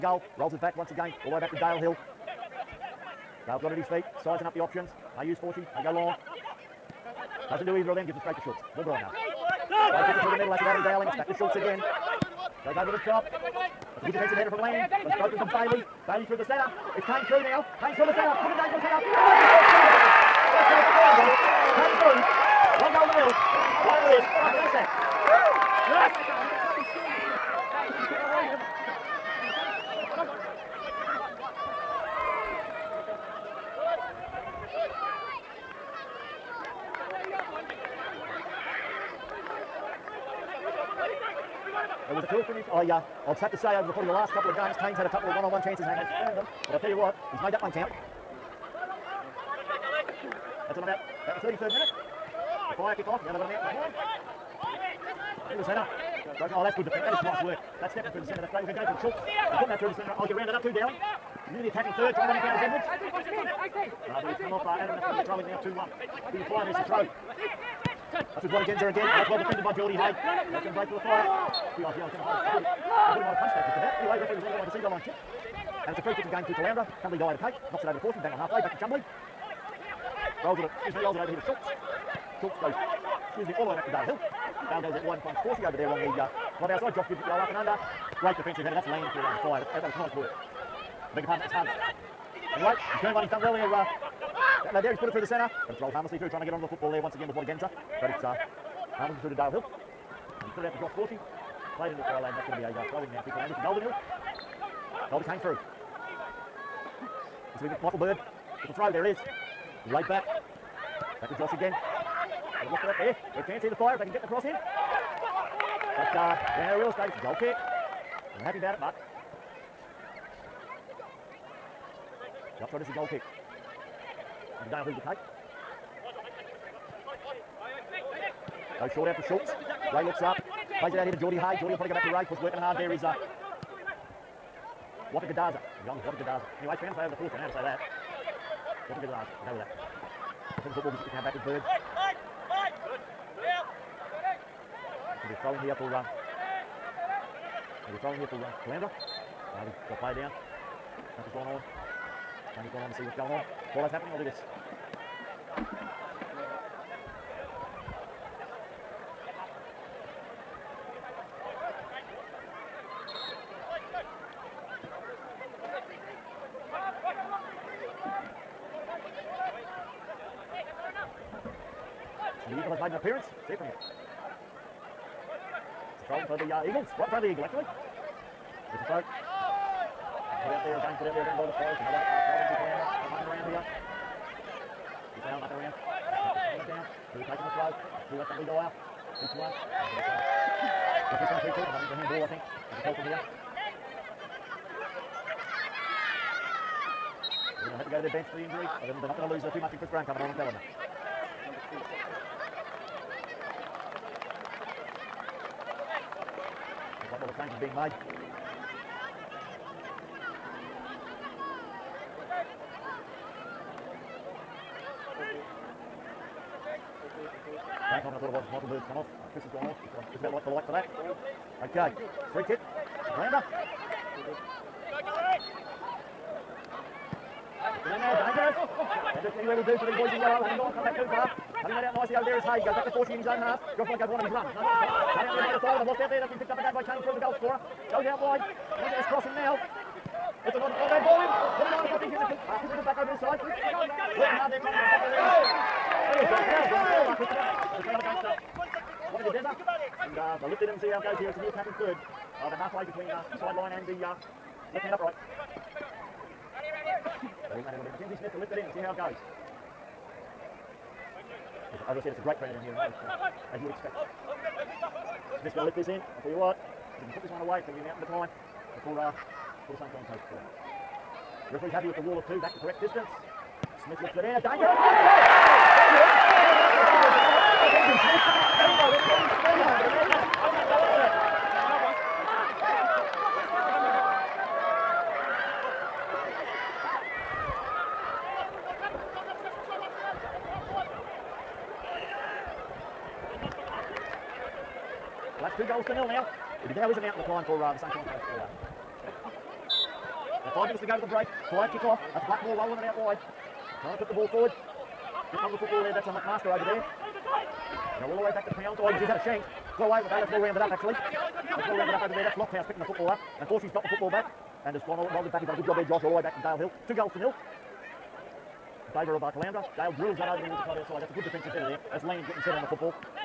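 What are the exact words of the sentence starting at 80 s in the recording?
Rolls it, excuse me, rolls it over here to Schultz.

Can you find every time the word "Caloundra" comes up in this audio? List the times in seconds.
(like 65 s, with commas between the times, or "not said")
103 s, 148 s, 182 s.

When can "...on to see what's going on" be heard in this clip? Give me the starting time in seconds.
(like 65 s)
152 s.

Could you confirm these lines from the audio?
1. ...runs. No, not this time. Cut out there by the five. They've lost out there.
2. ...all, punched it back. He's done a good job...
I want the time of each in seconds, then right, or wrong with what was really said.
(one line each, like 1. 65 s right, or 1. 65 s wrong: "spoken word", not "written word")
1. 234 s right
2. 314 s wrong: "rolled", not "punched".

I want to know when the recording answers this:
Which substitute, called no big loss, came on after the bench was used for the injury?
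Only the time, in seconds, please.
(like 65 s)
199 s.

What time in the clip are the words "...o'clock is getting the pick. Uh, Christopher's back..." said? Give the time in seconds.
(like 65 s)
241 s.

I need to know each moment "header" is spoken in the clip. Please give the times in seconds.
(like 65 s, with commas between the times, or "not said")
14 s, 18 s, 88 s, 321 s.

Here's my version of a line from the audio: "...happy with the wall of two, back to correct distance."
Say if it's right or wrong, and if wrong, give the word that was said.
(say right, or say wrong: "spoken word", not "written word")
right.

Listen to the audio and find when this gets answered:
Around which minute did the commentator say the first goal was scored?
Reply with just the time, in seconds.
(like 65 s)
51 s.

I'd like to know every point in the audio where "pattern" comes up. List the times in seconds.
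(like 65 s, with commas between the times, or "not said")
251 s.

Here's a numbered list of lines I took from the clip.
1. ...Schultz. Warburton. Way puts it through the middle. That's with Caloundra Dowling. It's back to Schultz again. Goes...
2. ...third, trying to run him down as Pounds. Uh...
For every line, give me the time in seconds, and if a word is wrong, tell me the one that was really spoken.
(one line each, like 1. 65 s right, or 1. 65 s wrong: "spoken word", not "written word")
1. 8 s wrong: "Adam", not "Caloundra"
2. 61 s wrong: "Edwards", not "Pounds".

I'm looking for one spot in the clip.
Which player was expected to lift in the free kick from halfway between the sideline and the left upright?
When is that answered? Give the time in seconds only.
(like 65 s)
257 s.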